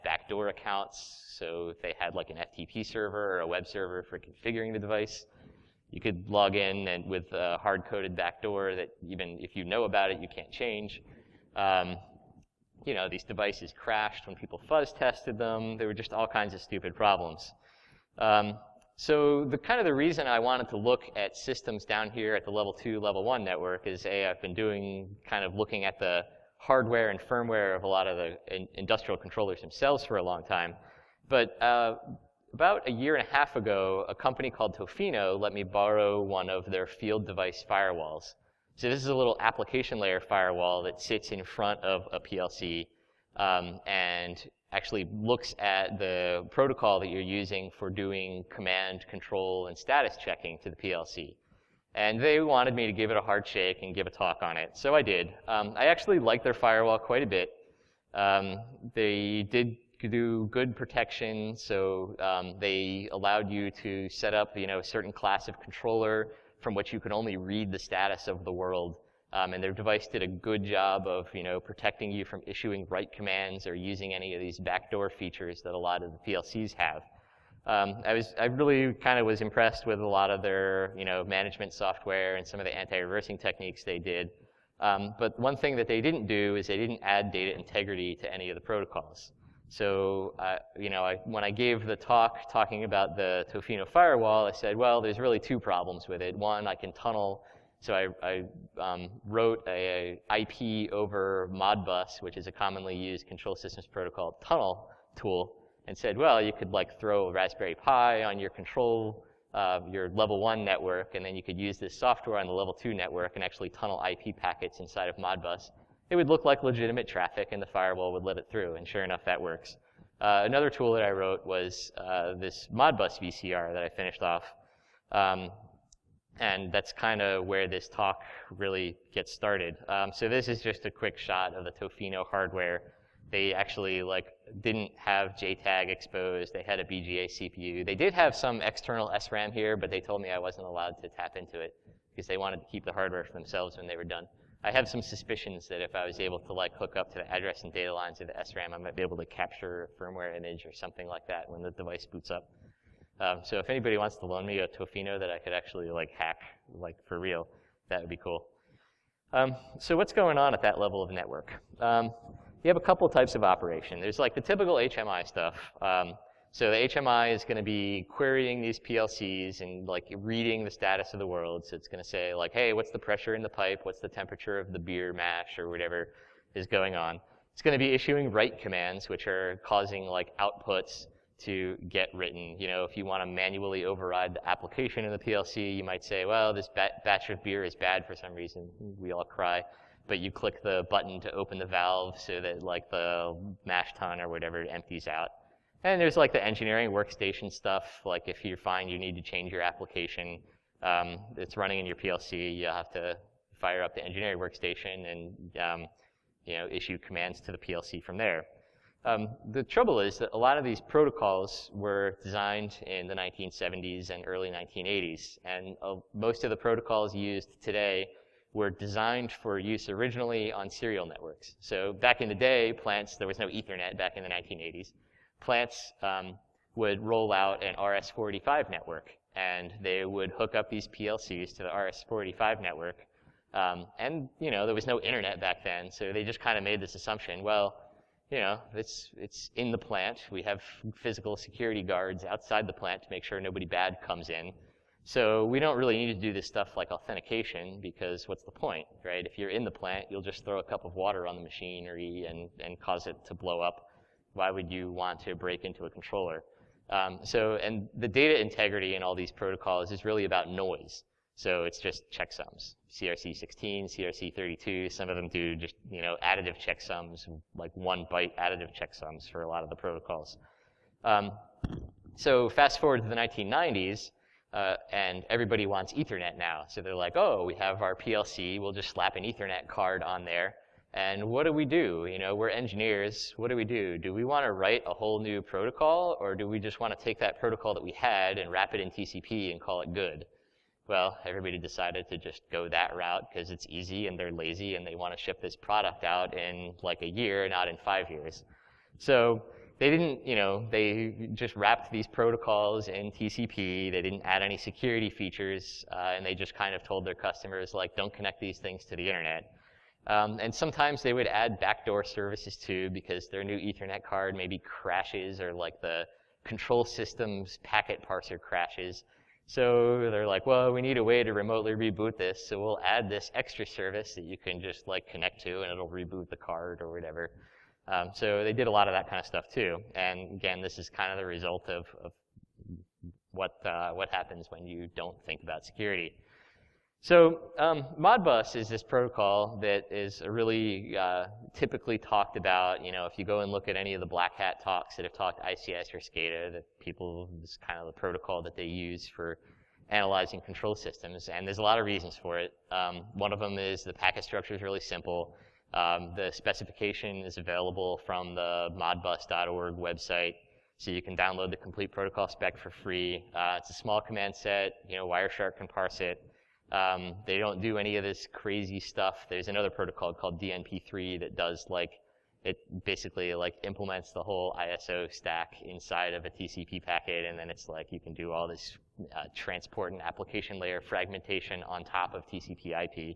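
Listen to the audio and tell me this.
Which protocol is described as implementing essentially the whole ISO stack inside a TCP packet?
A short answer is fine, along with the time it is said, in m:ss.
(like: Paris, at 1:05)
DNP3, at 6:10.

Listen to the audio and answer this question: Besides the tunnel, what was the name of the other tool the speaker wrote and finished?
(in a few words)
Modbus VCR.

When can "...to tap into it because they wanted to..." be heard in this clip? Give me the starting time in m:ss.
2:21.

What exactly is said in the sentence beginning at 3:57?
Well, you know it's it's in the plant.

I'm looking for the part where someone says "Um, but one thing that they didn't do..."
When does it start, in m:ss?
1:24.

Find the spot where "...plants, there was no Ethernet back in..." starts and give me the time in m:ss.
3:42.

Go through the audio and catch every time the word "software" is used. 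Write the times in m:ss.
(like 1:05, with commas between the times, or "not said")
1:21, 1:51.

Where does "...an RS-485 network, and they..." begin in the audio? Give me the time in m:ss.
3:47.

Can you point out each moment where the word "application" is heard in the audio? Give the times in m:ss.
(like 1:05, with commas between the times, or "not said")
0:39, 3:04, 3:19, 6:20.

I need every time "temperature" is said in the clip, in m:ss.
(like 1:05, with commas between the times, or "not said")
2:54.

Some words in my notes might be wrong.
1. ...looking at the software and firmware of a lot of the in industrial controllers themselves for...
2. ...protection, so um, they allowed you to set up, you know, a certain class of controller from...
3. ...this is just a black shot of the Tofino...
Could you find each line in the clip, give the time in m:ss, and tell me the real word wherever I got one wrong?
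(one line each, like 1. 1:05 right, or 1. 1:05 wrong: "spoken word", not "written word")
1. 0:25 wrong: "hardware", not "software"
2. 1:00 right
3. 2:10 wrong: "quick", not "black".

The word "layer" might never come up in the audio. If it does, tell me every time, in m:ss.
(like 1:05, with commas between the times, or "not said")
0:39, 6:20.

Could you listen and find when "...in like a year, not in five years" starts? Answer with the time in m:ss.
4:56.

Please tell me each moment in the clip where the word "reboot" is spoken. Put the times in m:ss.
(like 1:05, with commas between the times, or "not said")
5:21, 5:25.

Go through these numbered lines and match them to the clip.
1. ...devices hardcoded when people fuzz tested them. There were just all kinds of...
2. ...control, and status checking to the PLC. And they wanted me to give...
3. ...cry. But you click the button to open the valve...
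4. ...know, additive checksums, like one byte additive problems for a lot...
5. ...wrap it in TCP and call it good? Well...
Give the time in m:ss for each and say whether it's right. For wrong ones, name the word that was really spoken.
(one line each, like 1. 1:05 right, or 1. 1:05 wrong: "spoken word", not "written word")
1. 0:13 wrong: "crashed", not "hardcoded"
2. 0:49 right
3. 3:09 right
4. 4:26 wrong: "checksums", not "problems"
5. 4:48 right.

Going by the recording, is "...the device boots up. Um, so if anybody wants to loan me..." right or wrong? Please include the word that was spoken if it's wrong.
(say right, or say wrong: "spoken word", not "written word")
right.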